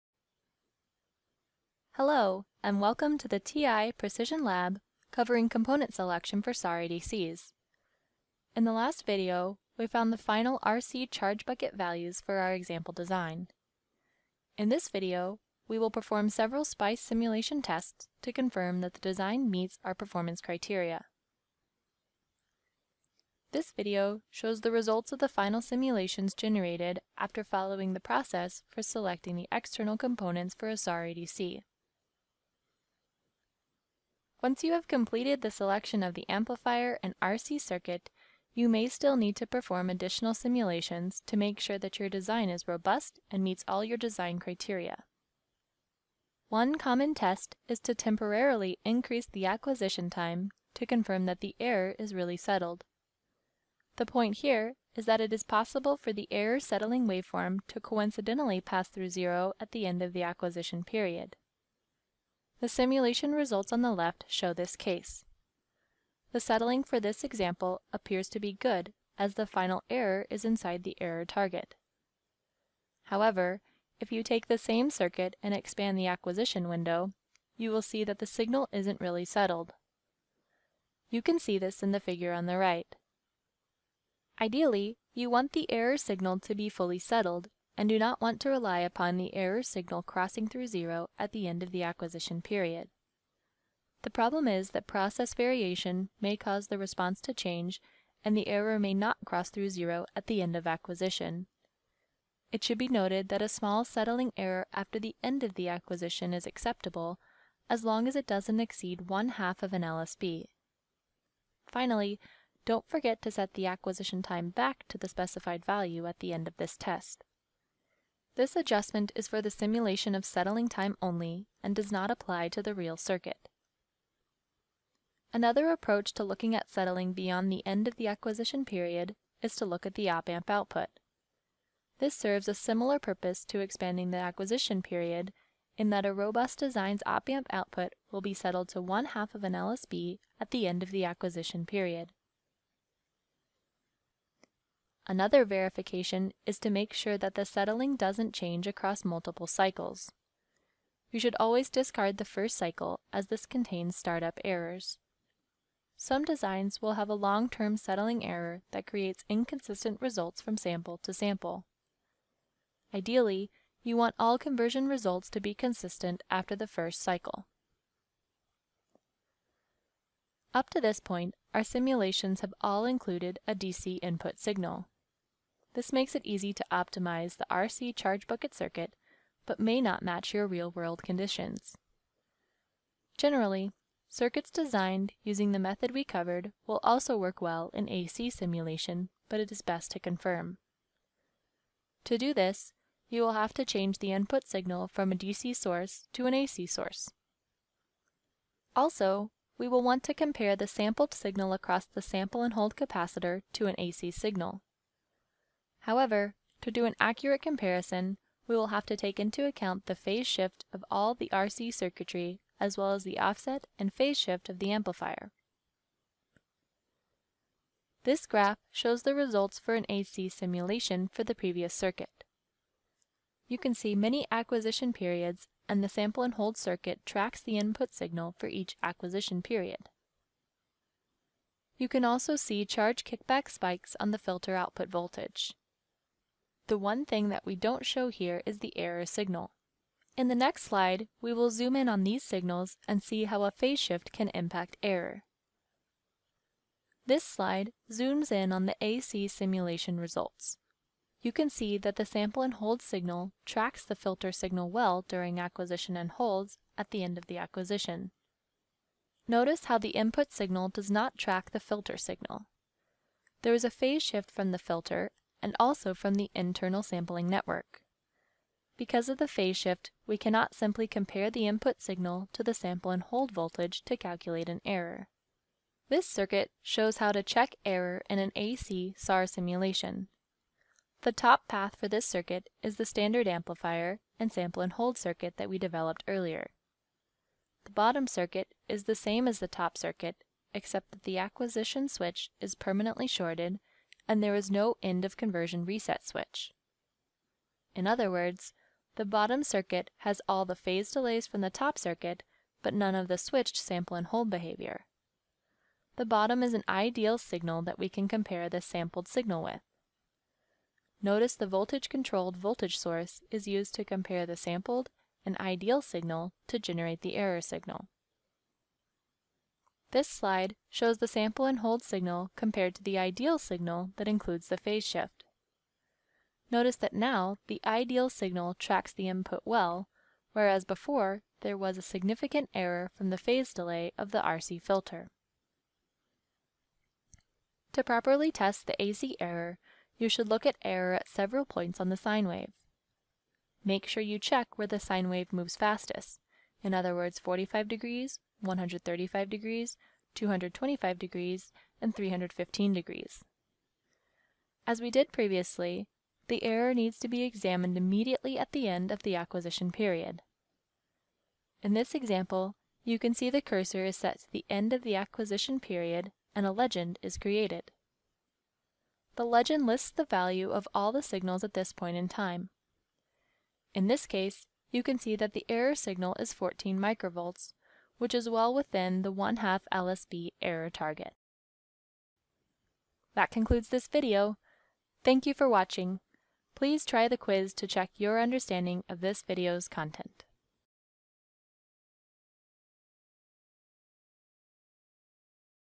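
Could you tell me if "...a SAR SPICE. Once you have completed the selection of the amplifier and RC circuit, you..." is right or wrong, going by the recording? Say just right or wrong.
wrong.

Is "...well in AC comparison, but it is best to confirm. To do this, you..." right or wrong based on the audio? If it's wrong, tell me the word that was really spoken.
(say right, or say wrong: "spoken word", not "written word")
wrong: "simulation", not "comparison".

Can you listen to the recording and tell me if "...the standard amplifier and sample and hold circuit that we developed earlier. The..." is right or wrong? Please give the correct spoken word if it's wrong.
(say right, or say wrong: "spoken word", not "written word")
right.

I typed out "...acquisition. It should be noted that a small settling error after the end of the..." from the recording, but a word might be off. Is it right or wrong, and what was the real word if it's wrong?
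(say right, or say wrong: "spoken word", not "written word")
right.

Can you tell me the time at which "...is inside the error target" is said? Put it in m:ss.
1:10.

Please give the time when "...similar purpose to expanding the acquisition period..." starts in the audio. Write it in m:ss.
2:12.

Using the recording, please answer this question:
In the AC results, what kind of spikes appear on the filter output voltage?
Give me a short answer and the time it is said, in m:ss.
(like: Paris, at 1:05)
Charge kickback spikes, at 3:52.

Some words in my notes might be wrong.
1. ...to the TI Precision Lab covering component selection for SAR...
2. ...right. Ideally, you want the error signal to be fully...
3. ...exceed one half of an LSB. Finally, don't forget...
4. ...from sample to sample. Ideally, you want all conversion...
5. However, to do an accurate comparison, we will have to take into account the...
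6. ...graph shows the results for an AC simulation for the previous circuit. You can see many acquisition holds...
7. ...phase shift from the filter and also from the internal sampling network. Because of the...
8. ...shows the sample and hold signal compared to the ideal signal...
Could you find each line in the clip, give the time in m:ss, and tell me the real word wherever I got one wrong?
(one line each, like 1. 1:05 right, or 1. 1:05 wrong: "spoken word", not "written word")
1. 0:03 right
2. 1:22 right
3. 1:48 right
4. 2:40 right
5. 3:25 right
6. 3:38 wrong: "periods", not "holds"
7. 4:23 right
8. 5:20 right.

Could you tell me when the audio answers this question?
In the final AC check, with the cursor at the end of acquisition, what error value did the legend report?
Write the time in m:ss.
6:16.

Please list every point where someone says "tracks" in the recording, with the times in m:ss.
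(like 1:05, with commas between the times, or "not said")
3:47, 4:13, 4:21, 5:28.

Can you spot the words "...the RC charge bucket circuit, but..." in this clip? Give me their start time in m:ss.
2:57.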